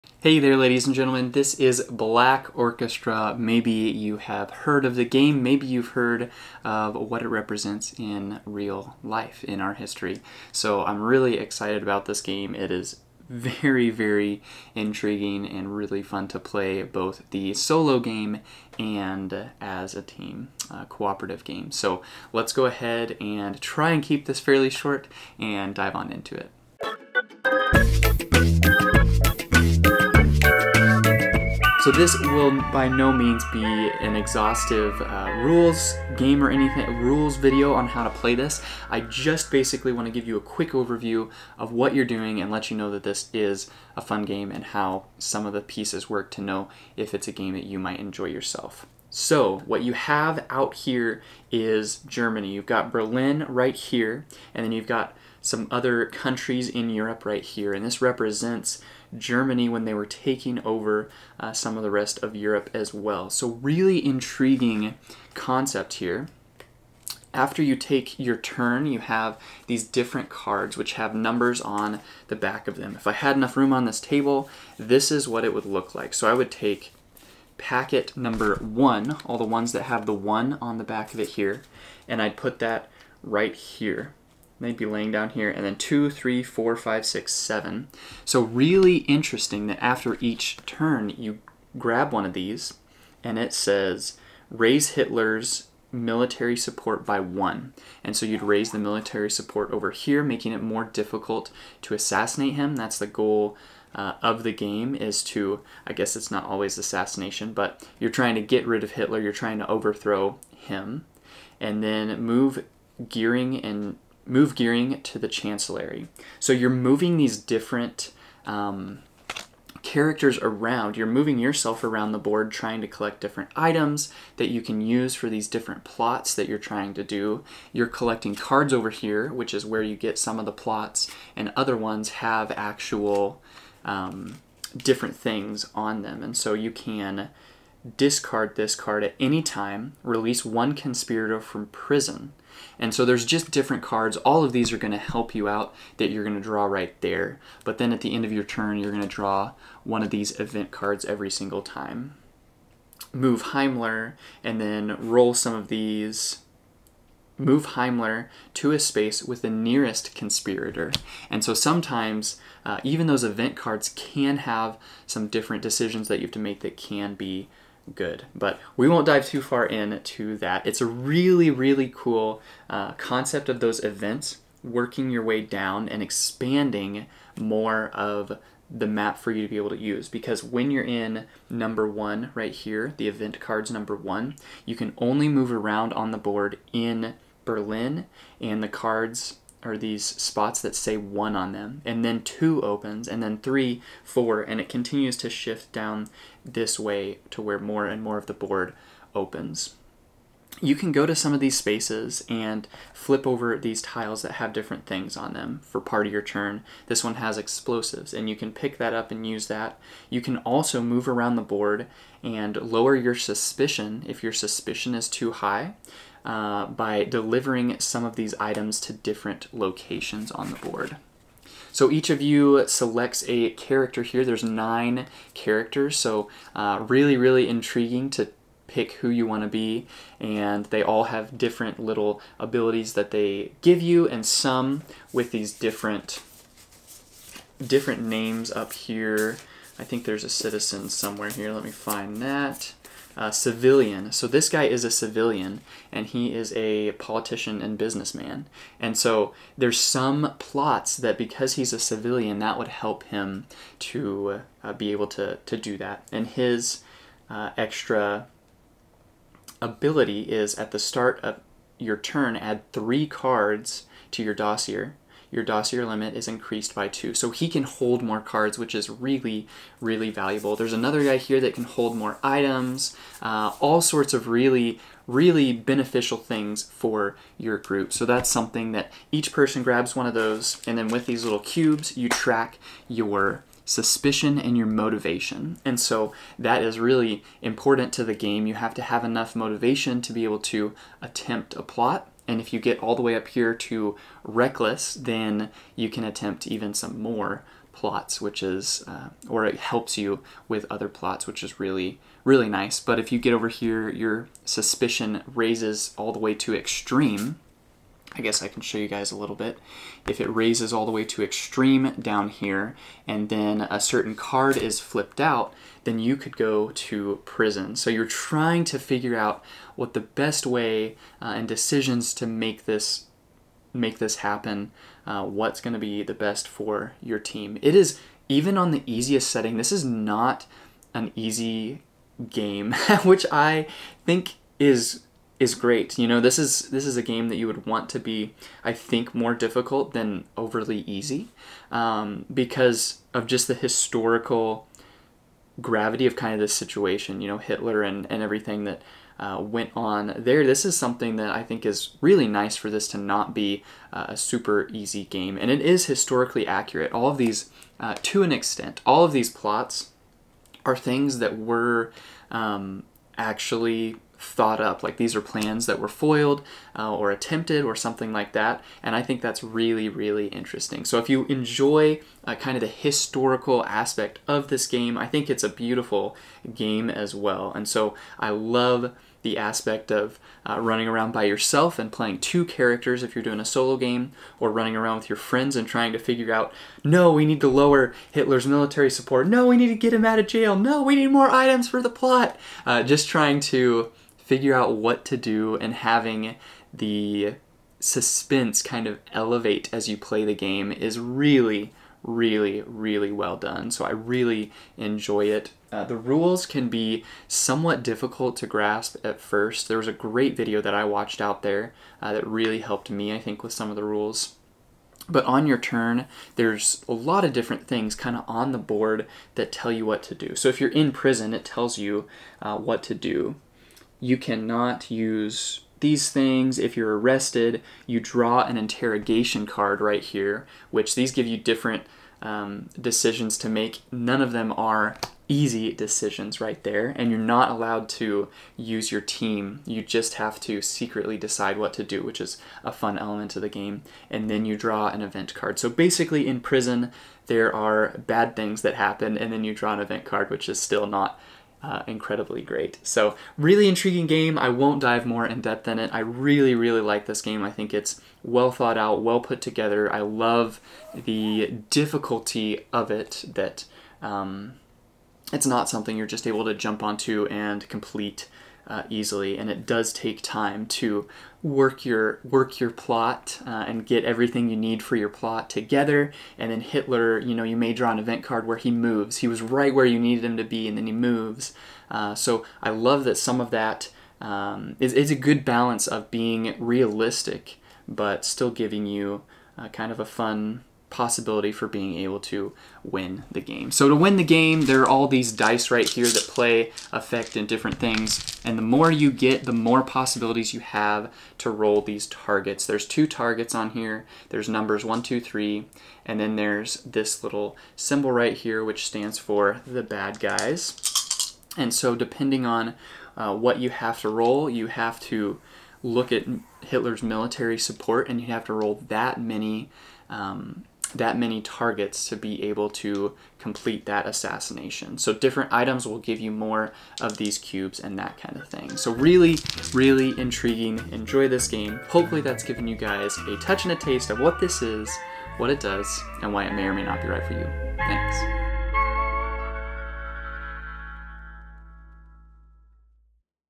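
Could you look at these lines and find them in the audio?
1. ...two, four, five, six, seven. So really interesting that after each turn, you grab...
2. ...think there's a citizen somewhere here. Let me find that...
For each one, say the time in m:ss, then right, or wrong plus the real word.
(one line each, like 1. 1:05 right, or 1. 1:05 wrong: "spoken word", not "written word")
1. 1:26 wrong: "three", not "two"
2. 3:59 right.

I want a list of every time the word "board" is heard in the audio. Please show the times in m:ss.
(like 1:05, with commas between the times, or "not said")
2:02, 3:06, 3:18, 3:31, 3:40, 6:58.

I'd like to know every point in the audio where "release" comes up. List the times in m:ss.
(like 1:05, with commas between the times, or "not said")
2:20.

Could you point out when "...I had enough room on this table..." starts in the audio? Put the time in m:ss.
1:13.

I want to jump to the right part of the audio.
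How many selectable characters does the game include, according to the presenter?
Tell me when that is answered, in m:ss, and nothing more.
3:44.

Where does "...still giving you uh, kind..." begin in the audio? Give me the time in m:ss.
8:08.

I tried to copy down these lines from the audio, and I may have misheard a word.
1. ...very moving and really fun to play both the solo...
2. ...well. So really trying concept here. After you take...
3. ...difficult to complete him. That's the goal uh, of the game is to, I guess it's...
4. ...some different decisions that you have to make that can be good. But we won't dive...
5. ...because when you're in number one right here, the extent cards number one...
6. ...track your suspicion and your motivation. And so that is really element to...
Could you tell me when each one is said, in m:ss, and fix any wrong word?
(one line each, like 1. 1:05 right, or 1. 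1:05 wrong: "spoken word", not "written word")
1. 0:13 wrong: "intriguing", not "moving"
2. 1:02 wrong: "intriguing", not "trying"
3. 1:40 wrong: "assassinate", not "complete"
4. 2:45 right
5. 3:00 wrong: "event", not "extent"
6. 4:42 wrong: "important", not "element".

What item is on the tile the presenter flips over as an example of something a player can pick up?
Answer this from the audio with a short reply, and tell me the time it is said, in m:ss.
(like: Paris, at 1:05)
Explosives, at 3:27.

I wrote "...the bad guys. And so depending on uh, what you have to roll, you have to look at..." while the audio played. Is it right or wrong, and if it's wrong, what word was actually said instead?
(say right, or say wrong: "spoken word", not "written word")
right.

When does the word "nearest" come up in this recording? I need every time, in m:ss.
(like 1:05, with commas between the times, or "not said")
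2:39.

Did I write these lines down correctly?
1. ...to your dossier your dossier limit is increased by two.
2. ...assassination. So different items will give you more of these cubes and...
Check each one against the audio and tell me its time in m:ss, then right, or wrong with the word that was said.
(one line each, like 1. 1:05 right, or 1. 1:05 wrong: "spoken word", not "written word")
1. 4:24 right
2. 8:44 right.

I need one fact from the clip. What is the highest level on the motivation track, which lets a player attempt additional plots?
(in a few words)
Reckless.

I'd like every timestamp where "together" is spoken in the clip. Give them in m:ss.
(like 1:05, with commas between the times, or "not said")
7:39, 7:55.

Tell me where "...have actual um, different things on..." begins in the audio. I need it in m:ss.
2:12.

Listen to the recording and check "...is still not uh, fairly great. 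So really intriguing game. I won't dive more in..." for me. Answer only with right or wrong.
wrong.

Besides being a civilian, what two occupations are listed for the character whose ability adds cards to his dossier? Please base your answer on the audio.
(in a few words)
Politician and businessman.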